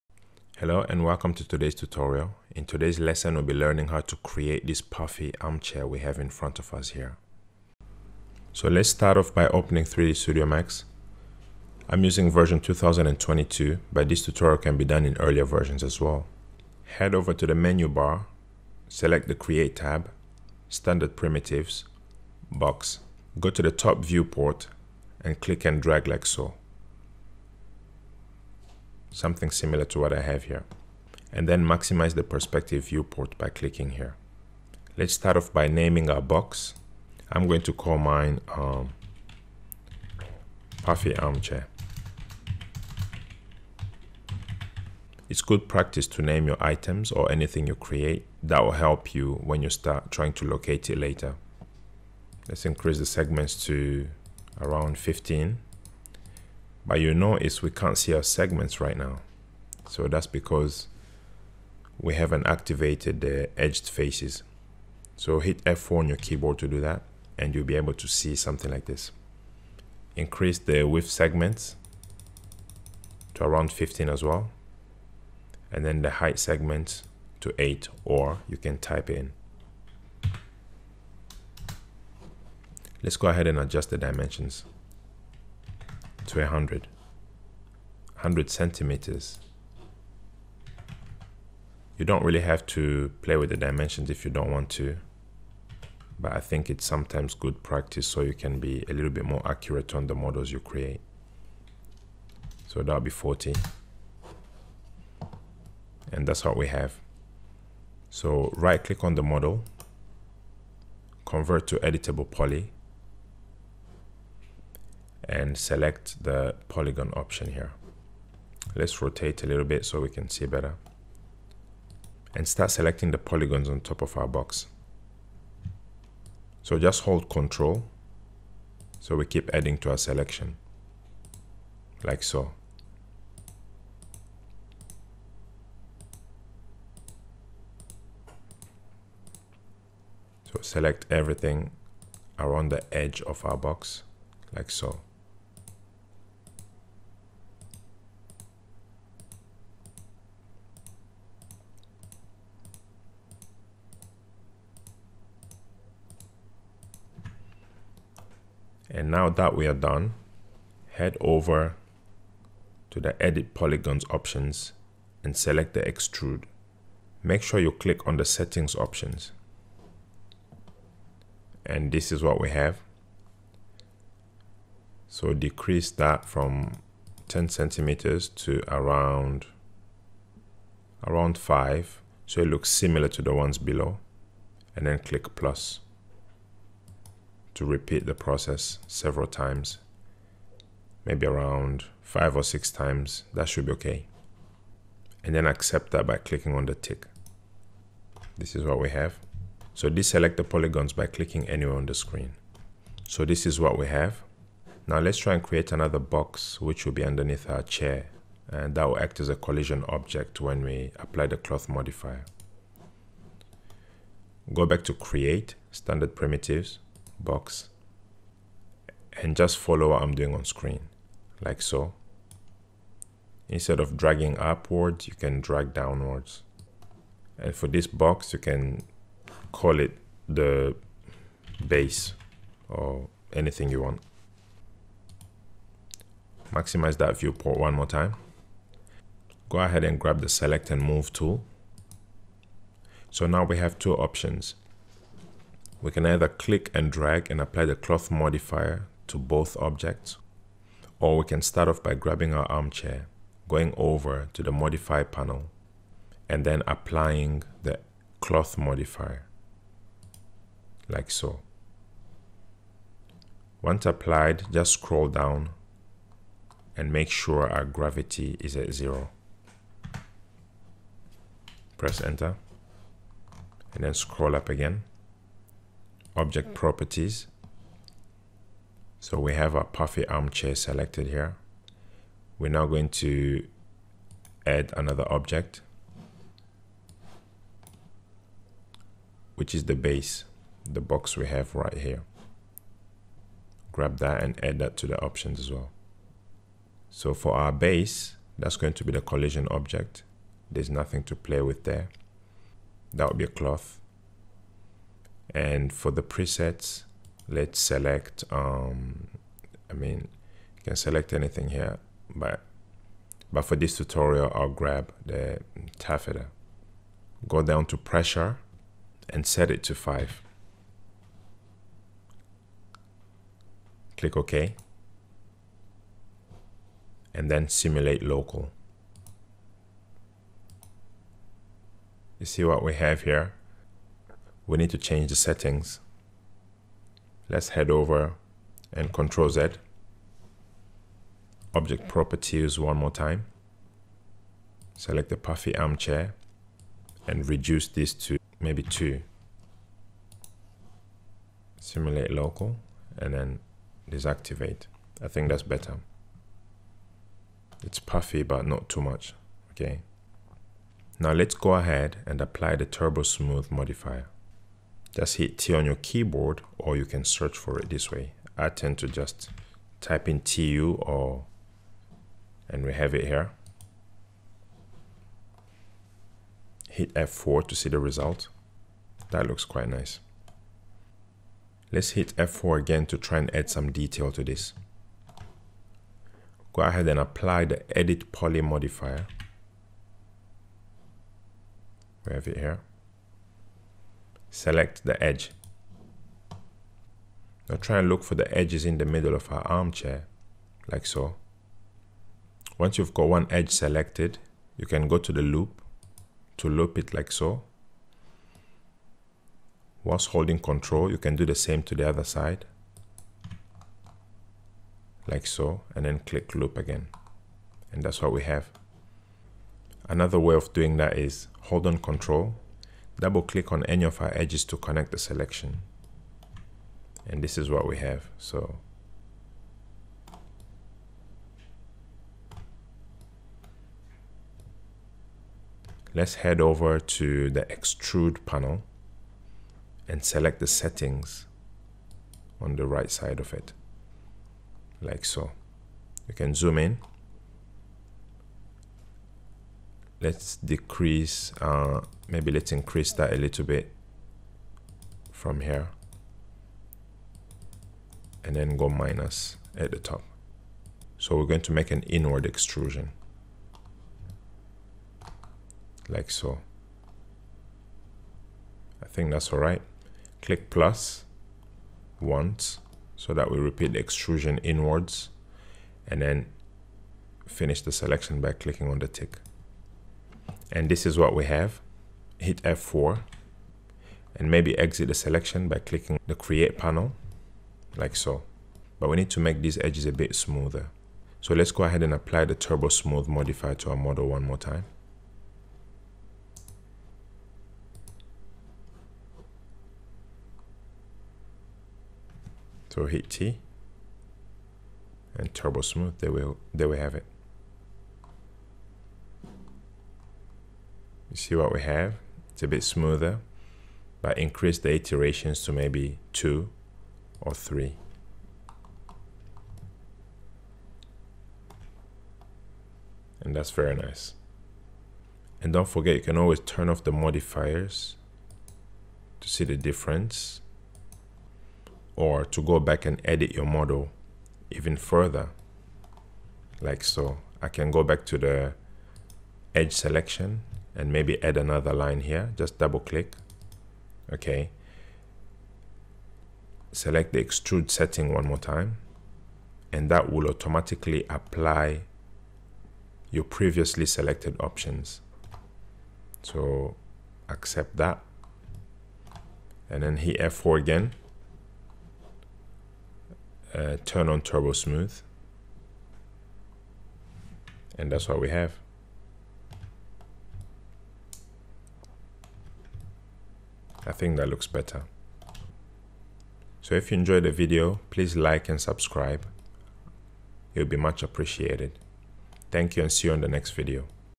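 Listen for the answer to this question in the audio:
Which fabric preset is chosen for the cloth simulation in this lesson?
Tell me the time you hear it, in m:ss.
5:15.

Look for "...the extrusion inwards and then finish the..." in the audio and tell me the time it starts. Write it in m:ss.
7:53.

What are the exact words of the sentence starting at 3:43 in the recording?
Instead of dragging upwards, you can drag downwards.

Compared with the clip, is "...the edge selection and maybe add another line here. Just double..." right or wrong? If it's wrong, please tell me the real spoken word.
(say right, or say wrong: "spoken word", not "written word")
right.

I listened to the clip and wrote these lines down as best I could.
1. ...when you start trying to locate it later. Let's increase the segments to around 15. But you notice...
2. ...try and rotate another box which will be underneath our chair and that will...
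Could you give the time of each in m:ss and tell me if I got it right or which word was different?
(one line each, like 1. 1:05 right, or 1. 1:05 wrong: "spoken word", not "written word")
1. 0:49 right
2. 3:25 wrong: "create", not "rotate".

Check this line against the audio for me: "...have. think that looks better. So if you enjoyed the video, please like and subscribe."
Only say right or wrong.
right.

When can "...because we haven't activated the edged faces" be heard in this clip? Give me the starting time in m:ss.
1:00.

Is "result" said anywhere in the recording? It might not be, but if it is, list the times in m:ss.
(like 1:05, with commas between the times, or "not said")
6:17.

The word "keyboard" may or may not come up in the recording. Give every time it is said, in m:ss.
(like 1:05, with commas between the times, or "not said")
1:06, 6:05.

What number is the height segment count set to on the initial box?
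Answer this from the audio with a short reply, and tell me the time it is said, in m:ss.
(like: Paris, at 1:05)
8, at 1:17.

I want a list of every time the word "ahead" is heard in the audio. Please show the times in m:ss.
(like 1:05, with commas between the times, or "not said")
1:23, 3:59, 6:01, 6:26, 8:11.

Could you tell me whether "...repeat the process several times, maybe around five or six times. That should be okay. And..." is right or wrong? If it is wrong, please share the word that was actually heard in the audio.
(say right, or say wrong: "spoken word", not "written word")
right.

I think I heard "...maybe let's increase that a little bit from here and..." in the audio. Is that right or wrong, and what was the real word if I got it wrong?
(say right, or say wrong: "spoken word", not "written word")
right.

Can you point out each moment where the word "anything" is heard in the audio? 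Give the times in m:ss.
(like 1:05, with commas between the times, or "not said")
0:47, 3:53, 5:11.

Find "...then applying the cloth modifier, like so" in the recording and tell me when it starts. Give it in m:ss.
4:16.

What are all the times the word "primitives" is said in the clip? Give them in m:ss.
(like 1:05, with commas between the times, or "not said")
0:21, 3:36.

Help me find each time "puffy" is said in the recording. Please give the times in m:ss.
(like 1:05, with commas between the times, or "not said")
0:04, 0:40, 4:39, 5:45, 5:57.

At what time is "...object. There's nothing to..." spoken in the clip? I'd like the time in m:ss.
4:59.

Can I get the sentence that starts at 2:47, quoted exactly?
Make sure you click on the settings options.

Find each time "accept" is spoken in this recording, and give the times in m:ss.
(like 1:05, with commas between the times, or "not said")
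3:15, 9:17.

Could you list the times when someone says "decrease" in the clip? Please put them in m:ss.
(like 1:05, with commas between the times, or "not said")
2:55, 7:30.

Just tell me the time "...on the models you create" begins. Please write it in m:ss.
1:39.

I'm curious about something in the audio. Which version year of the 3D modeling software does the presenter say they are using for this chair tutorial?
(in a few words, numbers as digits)
2022.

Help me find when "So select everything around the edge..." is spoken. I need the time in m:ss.
2:20.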